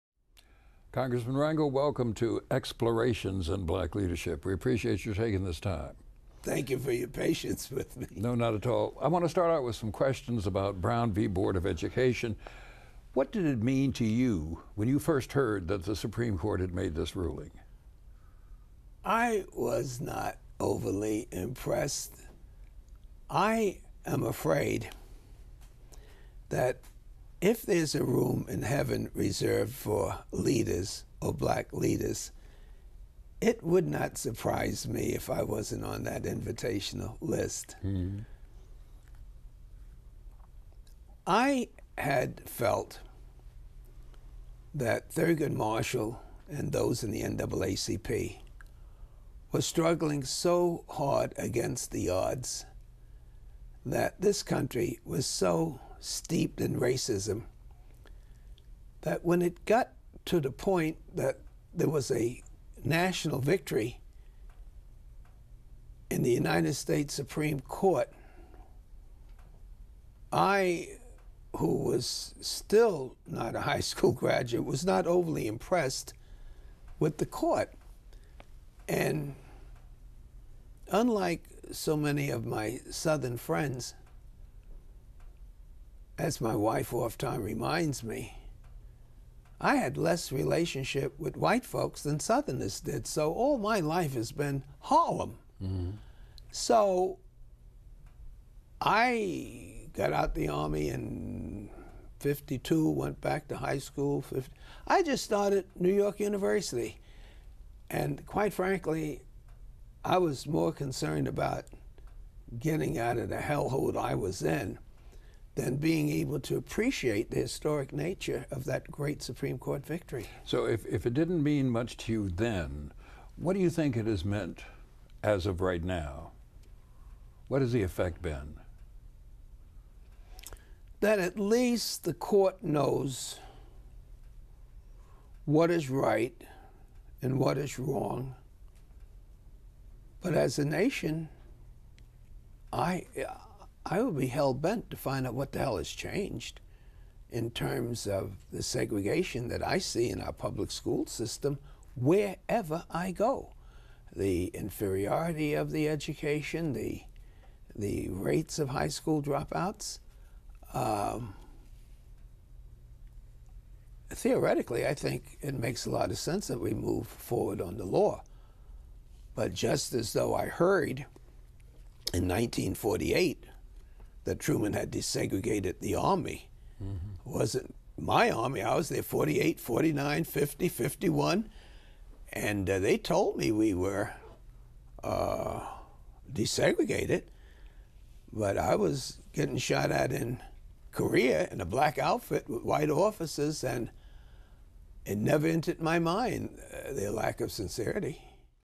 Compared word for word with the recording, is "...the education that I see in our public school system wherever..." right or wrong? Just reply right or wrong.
wrong.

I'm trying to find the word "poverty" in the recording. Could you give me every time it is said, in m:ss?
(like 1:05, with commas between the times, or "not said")
not said.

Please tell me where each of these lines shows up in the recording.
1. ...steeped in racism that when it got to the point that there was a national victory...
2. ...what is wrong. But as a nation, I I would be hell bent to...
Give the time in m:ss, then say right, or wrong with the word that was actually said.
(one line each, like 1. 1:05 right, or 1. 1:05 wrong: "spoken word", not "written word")
1. 0:56 right
2. 2:17 right.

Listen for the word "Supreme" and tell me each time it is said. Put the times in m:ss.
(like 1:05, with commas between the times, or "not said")
0:15, 1:07, 1:59.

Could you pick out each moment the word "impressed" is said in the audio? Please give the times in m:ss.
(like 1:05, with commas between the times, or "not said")
0:21, 1:15.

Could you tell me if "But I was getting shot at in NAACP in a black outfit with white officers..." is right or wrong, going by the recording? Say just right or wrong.
wrong.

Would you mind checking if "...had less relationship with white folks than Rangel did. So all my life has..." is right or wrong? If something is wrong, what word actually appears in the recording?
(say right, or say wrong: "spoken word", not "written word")
wrong: "Southerners", not "Rangel".